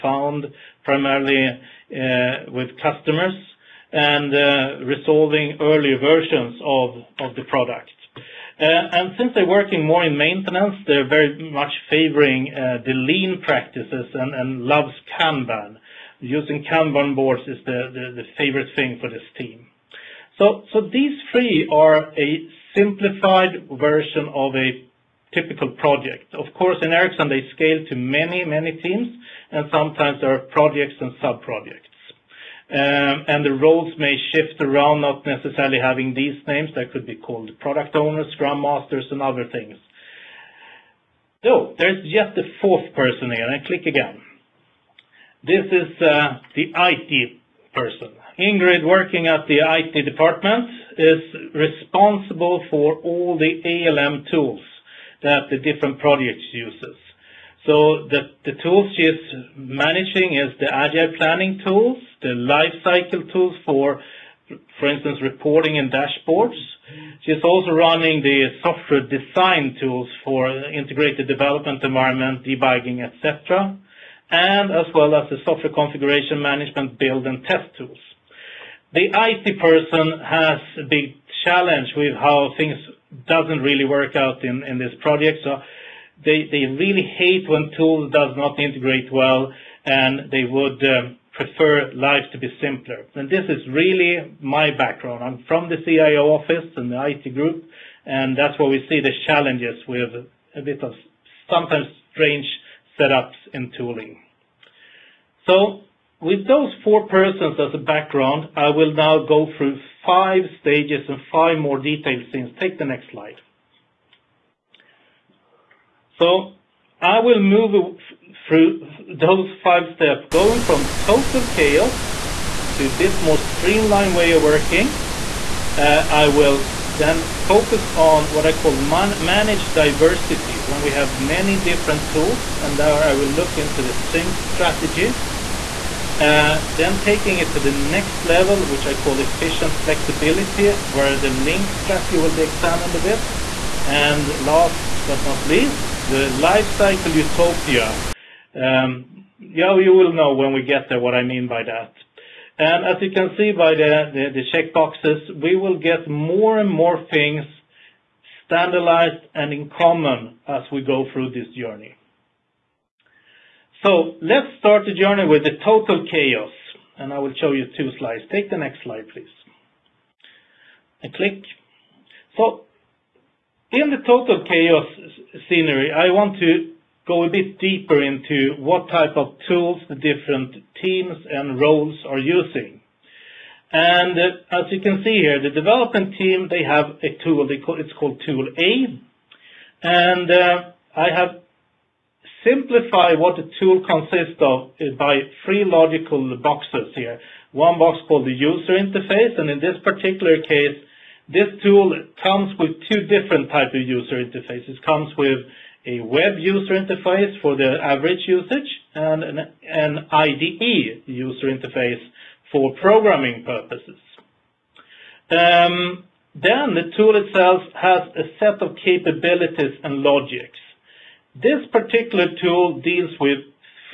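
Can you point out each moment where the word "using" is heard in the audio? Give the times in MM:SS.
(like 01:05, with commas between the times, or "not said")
00:16, 03:02.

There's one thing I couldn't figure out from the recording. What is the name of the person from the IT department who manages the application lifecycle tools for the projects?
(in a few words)
Ingrid.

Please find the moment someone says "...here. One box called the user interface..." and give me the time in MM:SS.
03:16.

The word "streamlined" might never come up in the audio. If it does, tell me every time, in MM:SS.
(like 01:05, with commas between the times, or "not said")
02:03.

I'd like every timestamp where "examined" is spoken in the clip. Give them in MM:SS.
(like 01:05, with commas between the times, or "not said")
02:22.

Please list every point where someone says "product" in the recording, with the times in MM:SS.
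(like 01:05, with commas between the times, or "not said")
00:07, 00:37.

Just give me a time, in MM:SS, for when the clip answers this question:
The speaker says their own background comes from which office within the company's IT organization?
01:35.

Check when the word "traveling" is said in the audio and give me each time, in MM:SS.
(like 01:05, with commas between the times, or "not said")
not said.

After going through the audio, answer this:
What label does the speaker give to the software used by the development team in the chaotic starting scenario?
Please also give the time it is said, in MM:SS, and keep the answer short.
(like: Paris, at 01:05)
Tool A, at 03:08.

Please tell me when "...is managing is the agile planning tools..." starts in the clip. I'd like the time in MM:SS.
00:59.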